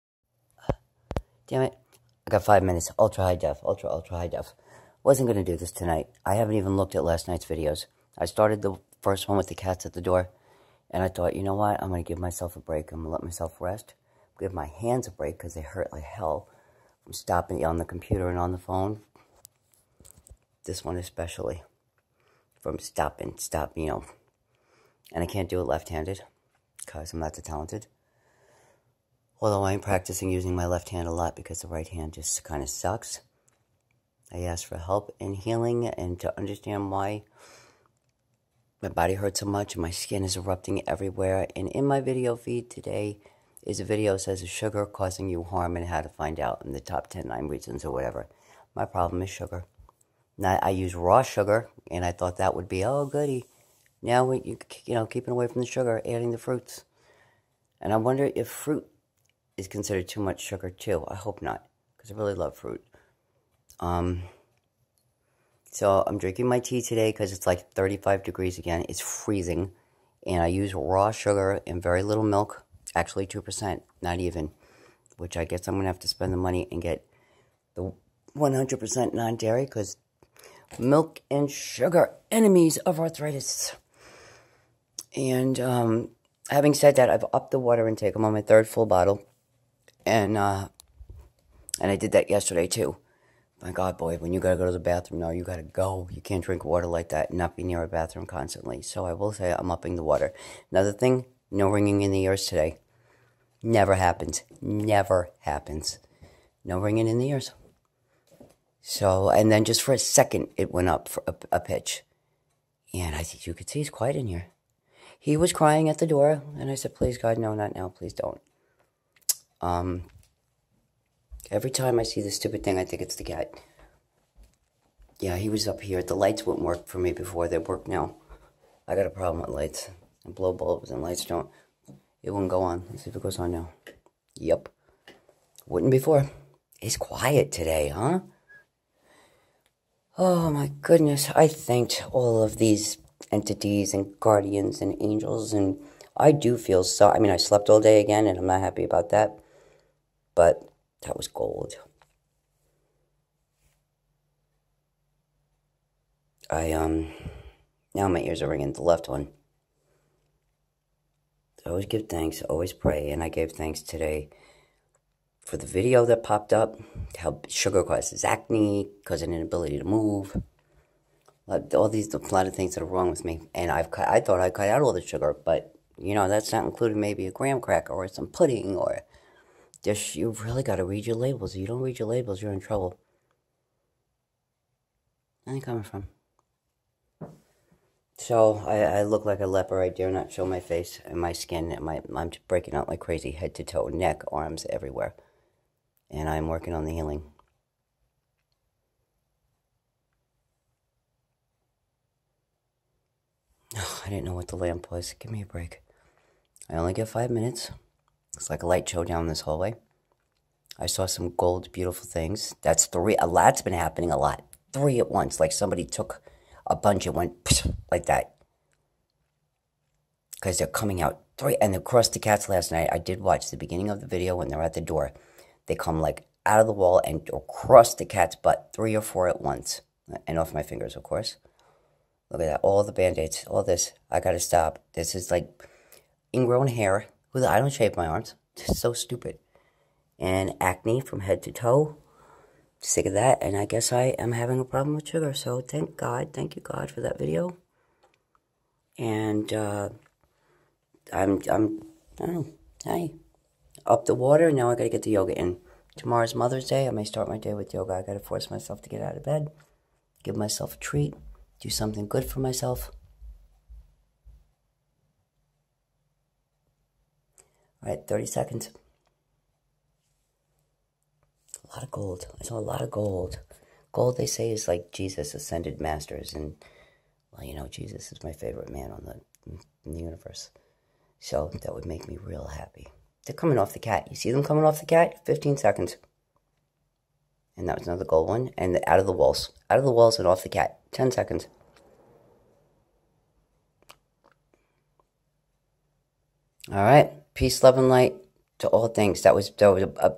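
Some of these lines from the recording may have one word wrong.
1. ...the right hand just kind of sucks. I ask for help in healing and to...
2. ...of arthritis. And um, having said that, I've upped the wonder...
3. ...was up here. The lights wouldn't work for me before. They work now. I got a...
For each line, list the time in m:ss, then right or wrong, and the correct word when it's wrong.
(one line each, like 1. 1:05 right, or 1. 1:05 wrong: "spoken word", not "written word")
1. 0:31 right
2. 1:22 wrong: "water", not "wonder"
3. 2:05 right.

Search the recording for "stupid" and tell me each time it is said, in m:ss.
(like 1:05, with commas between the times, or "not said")
2:02, 3:58.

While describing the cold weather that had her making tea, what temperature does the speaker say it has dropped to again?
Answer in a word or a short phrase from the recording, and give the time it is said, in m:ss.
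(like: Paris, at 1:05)
35 degrees, at 1:07.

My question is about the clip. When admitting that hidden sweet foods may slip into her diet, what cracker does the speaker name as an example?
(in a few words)
graham cracker.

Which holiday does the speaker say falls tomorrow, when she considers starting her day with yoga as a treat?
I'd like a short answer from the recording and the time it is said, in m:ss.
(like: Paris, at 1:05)
Mother's Day, at 4:16.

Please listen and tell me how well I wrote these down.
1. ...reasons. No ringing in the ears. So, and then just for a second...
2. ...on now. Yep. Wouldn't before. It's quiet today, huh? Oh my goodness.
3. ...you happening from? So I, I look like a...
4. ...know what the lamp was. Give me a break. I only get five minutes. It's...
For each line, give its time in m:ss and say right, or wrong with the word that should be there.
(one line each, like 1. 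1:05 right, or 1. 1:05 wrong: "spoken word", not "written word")
1. 1:45 wrong: "happens", not "reasons"
2. 2:13 right
3. 3:05 wrong: "coming", not "happening"
4. 3:24 right.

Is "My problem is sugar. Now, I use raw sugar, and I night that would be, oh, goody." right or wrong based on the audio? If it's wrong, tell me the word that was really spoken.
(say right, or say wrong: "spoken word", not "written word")
wrong: "thought", not "night".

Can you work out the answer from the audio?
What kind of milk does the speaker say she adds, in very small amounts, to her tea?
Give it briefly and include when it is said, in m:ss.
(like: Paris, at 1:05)
2 percent, at 1:13.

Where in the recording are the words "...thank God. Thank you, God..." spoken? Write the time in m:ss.
4:05.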